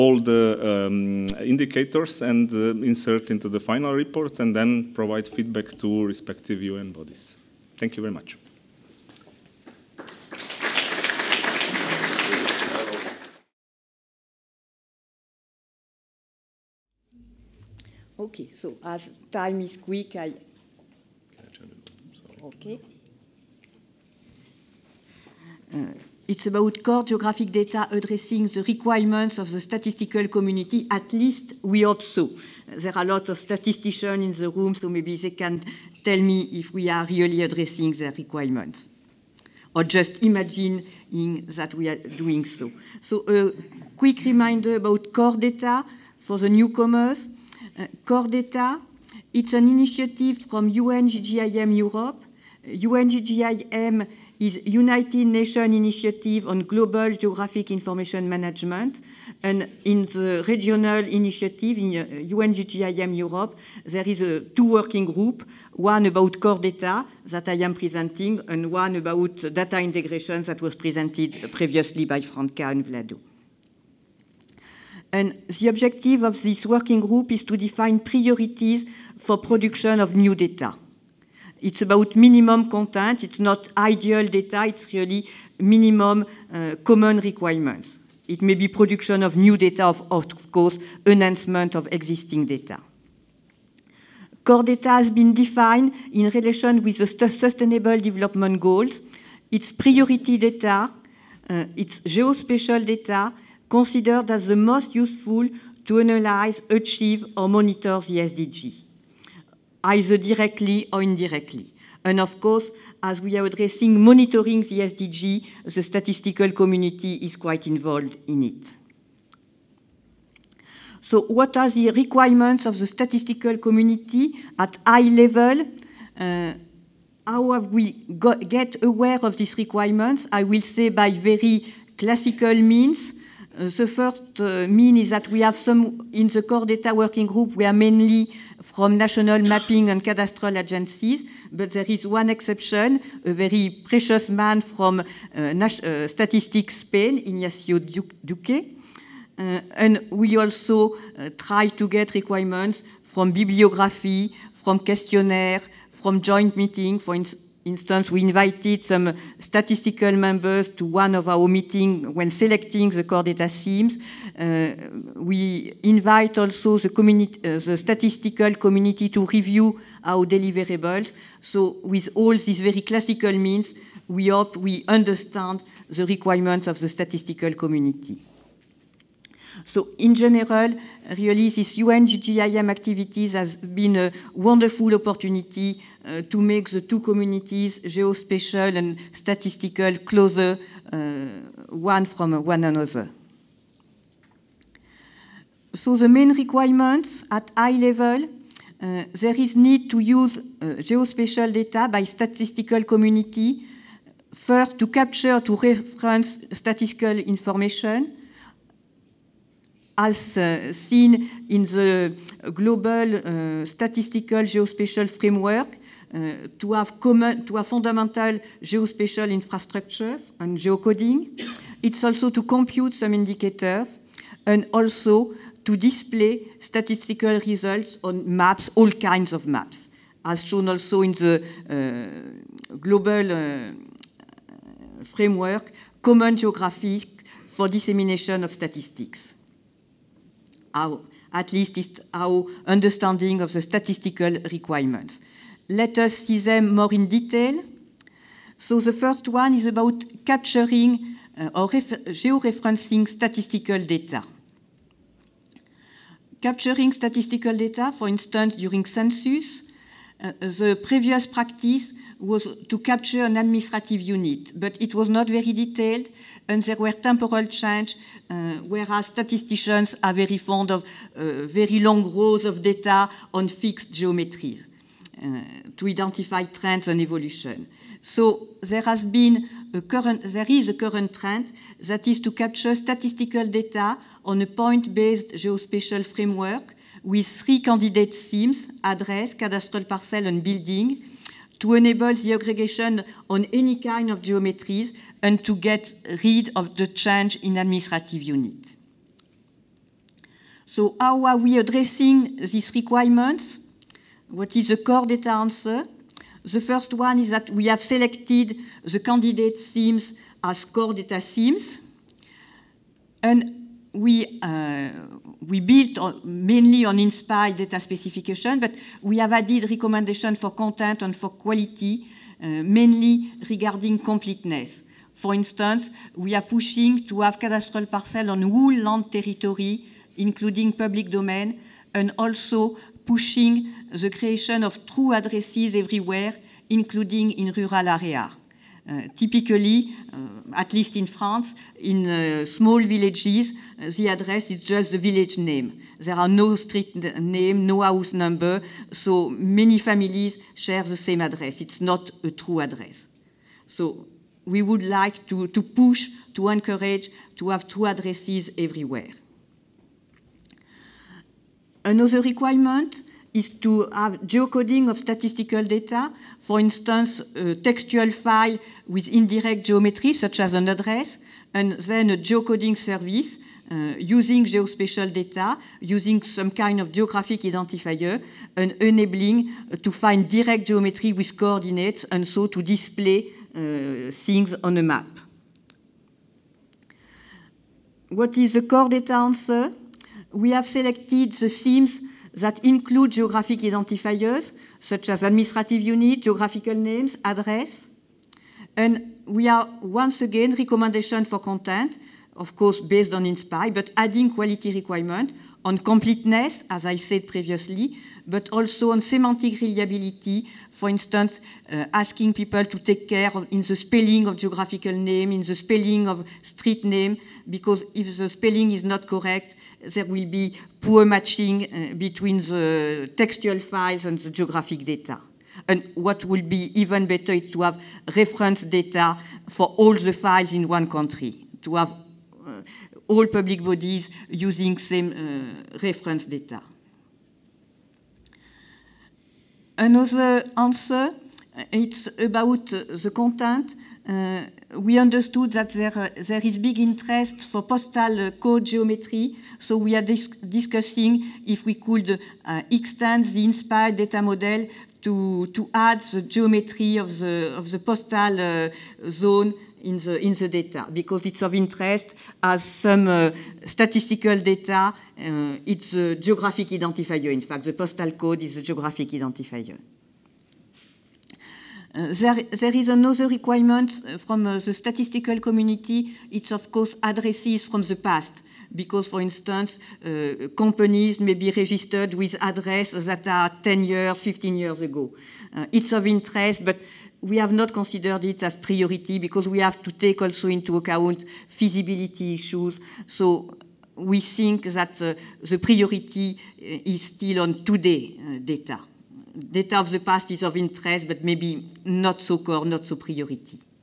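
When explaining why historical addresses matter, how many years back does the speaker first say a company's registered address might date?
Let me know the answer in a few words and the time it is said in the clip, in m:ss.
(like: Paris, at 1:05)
10 years, at 8:03.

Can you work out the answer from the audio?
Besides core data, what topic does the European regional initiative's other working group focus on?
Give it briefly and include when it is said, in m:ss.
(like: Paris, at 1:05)
data integration, at 1:09.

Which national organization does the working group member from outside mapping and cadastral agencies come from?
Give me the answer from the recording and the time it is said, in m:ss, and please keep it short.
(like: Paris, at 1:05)
Statistics Spain, at 2:26.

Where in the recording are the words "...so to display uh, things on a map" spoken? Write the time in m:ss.
6:22.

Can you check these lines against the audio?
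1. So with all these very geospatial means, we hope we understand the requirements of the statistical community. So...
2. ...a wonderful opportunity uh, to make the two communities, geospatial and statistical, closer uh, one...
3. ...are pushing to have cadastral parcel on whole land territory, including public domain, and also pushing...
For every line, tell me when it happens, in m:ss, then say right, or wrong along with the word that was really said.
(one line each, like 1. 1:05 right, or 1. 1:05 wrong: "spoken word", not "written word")
1. 2:51 wrong: "classical", not "geospatial"
2. 3:03 right
3. 5:26 right.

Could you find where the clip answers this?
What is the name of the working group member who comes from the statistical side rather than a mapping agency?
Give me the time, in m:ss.
2:27.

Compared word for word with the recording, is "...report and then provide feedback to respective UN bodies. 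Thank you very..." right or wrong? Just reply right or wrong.
right.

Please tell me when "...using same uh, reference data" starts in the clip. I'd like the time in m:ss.
7:14.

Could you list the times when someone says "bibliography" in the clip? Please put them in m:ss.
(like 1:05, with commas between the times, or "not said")
2:33.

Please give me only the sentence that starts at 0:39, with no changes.
Or just imagine that we are doing so.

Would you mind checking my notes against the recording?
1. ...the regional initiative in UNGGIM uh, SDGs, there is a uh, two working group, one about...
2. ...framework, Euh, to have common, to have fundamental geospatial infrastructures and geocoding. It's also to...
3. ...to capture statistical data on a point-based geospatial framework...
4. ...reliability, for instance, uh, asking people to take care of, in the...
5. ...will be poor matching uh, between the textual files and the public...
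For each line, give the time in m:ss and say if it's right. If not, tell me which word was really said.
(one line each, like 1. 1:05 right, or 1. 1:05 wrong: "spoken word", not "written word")
1. 1:00 wrong: "Europe", not "SDGs"
2. 3:35 right
3. 4:42 right
4. 6:49 right
5. 7:00 wrong: "geographic", not "public".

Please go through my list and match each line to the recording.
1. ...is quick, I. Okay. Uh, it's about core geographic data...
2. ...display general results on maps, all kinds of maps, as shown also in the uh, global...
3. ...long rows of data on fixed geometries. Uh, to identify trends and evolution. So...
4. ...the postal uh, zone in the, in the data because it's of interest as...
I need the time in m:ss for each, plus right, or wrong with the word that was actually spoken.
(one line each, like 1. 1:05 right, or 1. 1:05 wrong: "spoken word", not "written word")
1. 0:19 right
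2. 3:45 wrong: "statistical", not "general"
3. 4:31 right
4. 7:37 right.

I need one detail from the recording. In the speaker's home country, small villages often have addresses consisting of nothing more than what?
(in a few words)
the village name.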